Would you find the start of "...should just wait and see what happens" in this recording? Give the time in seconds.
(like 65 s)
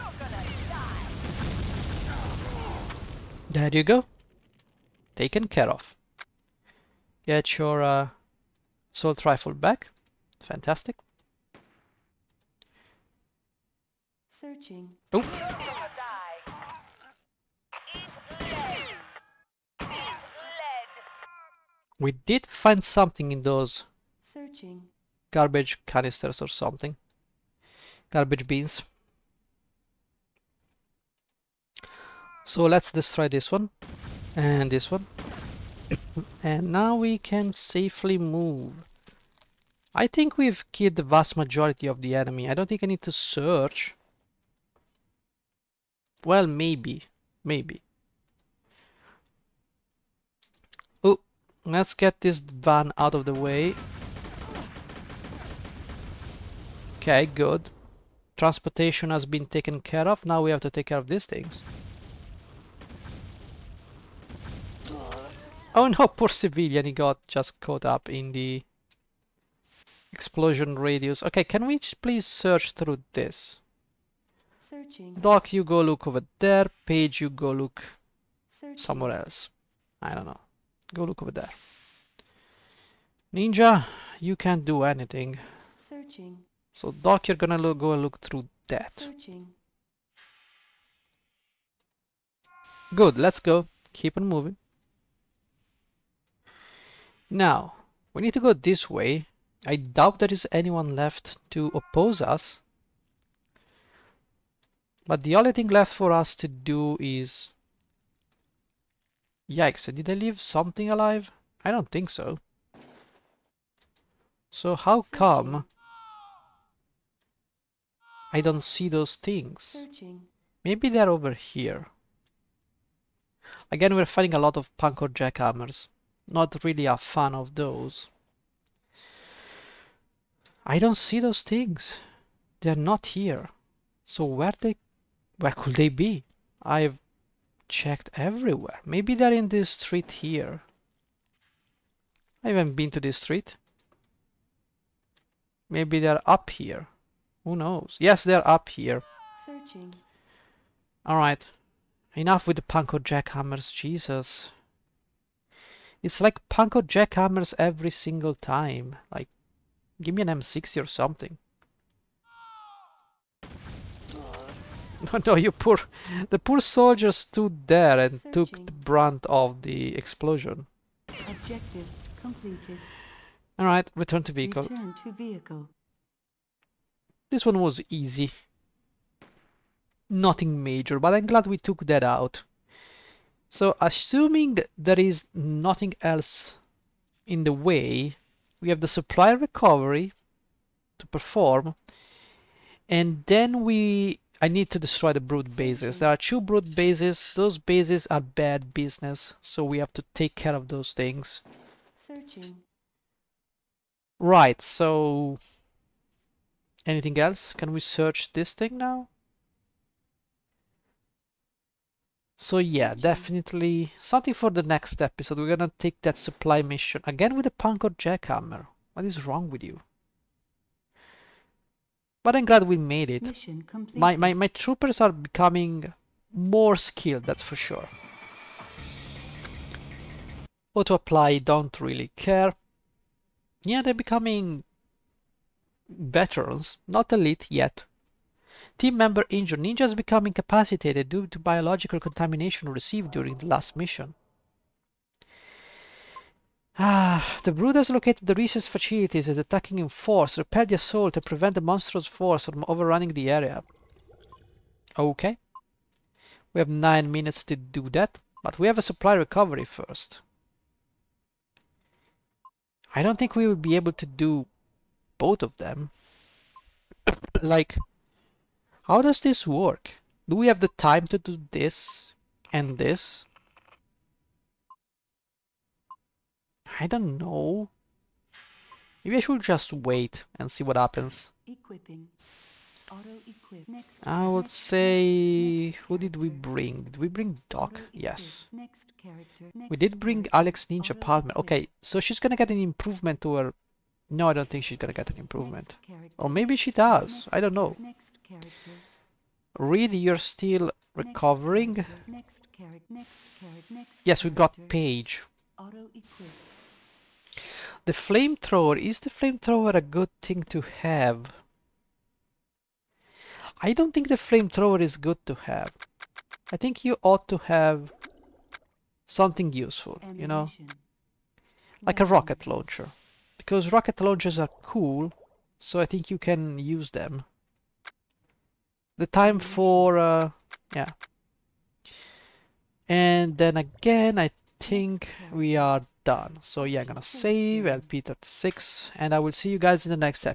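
279 s.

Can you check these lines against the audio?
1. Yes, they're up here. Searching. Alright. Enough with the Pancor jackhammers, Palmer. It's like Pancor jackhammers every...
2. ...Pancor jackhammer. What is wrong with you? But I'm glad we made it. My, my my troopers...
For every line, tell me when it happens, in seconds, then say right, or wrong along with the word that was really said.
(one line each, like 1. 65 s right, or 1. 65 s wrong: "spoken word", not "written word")
1. 147 s wrong: "Jesus", not "Palmer"
2. 217 s right.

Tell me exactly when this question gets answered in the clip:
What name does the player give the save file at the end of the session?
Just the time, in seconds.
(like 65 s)
337 s.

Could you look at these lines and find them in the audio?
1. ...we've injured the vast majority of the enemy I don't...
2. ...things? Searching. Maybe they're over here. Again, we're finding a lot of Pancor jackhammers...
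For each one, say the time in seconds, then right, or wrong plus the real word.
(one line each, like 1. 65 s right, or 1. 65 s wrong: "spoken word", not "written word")
1. 40 s wrong: "killed", not "injured"
2. 119 s right.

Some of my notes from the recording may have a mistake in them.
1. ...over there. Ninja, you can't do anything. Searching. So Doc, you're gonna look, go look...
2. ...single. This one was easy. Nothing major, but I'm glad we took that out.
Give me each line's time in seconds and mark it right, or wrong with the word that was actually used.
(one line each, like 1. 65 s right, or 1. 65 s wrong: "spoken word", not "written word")
1. 81 s right
2. 175 s wrong: "vehicle", not "single".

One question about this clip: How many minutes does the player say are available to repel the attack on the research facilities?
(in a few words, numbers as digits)
9.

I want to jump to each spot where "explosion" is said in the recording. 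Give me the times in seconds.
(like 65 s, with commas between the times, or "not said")
70 s, 169 s.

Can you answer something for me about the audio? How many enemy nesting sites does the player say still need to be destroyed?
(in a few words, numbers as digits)
2.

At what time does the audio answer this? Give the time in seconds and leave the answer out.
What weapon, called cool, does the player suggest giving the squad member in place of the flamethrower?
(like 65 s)
322 s.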